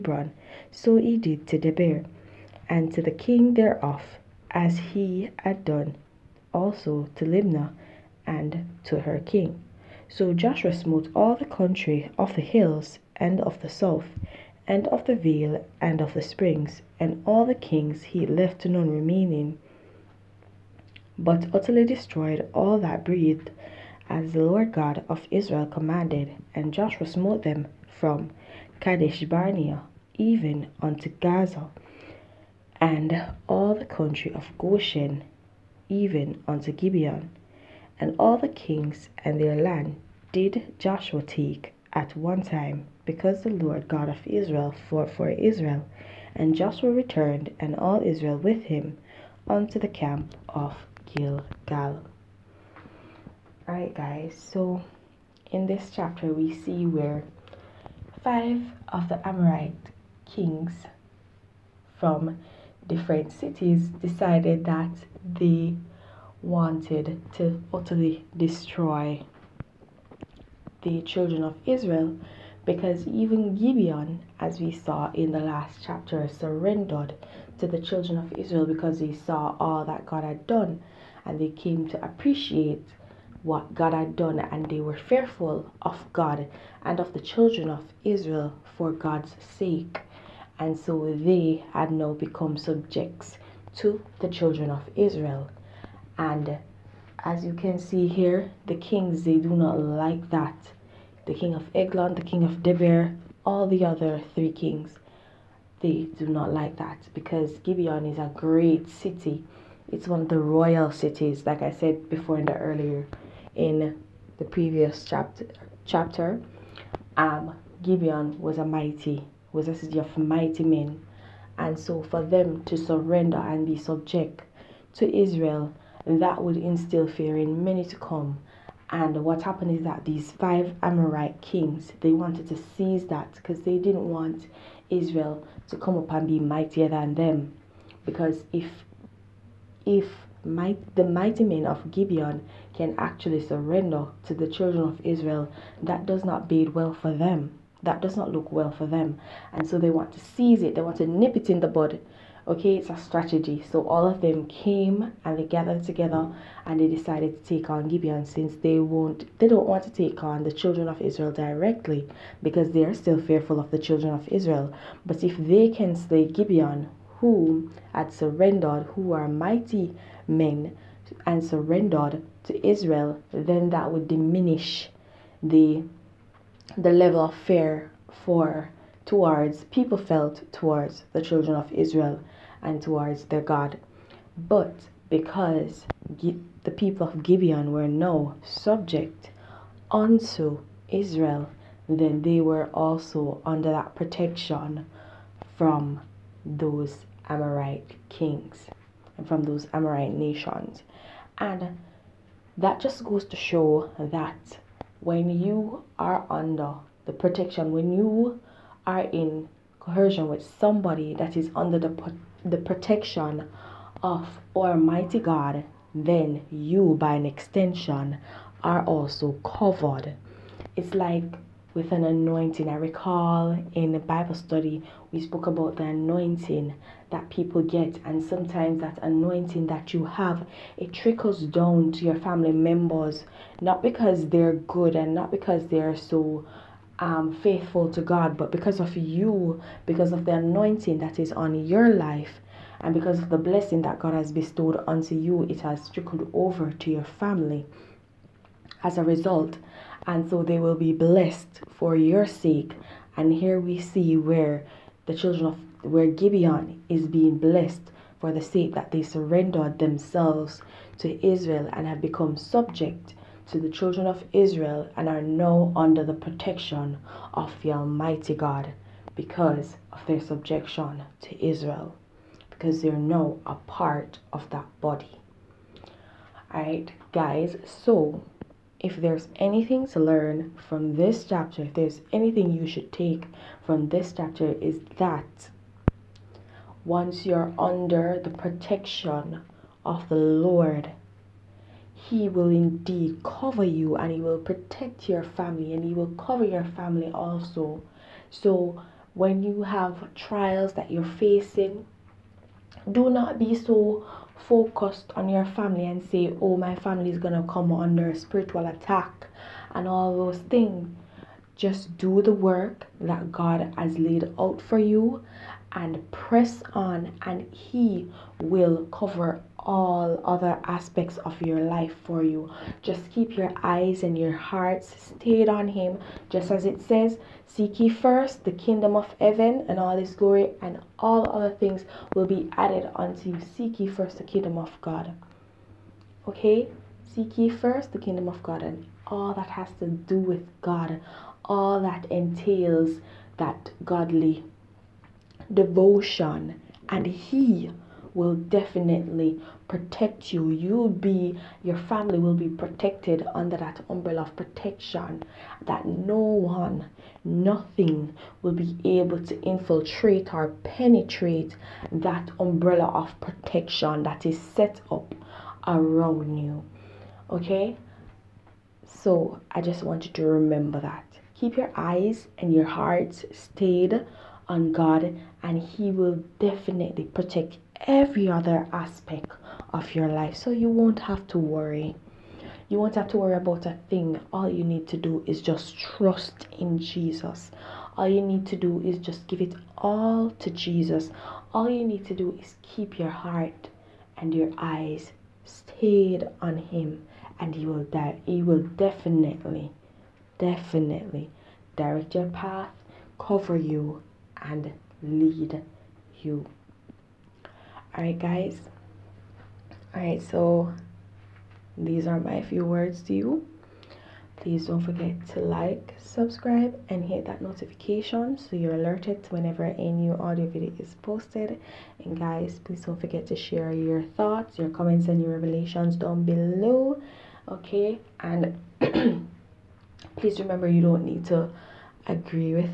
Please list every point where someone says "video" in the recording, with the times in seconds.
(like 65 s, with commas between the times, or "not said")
420 s.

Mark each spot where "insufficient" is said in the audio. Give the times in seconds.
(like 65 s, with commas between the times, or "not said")
not said.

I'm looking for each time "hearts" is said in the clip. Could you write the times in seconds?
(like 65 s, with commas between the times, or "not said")
324 s, 372 s, 393 s.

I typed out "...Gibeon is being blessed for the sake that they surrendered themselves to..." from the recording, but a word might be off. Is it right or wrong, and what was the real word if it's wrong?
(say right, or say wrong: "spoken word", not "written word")
right.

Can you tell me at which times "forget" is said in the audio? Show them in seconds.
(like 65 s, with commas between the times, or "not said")
414 s, 423 s.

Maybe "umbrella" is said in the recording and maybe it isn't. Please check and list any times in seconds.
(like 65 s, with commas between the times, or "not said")
353 s, 362 s.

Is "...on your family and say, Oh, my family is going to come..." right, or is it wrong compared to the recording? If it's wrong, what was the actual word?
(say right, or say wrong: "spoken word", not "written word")
right.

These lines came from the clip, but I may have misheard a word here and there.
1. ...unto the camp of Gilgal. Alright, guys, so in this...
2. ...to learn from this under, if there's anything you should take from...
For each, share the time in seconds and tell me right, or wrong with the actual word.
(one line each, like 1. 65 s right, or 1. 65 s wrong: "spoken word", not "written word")
1. 49 s right
2. 279 s wrong: "chapter", not "under".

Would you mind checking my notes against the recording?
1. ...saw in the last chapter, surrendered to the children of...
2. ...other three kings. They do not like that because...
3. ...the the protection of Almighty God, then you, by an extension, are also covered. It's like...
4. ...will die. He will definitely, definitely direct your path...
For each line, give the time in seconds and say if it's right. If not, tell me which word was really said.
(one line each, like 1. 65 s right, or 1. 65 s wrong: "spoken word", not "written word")
1. 74 s right
2. 103 s right
3. 211 s right
4. 397 s right.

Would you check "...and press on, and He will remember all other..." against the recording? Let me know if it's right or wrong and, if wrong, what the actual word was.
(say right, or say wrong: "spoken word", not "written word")
wrong: "cover", not "remember".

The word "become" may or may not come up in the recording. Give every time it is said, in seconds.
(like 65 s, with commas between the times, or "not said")
92 s, 262 s.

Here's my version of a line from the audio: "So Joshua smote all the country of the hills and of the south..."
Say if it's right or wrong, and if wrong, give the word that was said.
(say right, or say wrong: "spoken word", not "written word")
right.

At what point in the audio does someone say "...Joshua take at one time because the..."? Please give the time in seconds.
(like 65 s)
40 s.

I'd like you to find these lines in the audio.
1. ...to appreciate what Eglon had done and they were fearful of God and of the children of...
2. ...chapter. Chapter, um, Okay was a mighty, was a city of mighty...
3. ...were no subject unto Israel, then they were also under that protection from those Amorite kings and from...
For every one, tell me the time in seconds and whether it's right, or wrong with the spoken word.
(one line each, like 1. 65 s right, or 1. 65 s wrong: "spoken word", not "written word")
1. 81 s wrong: "God", not "Eglon"
2. 115 s wrong: "Gibeon", not "Okay"
3. 187 s right.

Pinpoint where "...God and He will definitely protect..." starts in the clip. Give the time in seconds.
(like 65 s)
374 s.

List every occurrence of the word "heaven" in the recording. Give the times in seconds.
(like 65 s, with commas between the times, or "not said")
329 s.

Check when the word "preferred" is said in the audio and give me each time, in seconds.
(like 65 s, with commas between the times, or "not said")
not said.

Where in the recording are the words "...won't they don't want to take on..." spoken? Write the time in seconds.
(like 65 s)
158 s.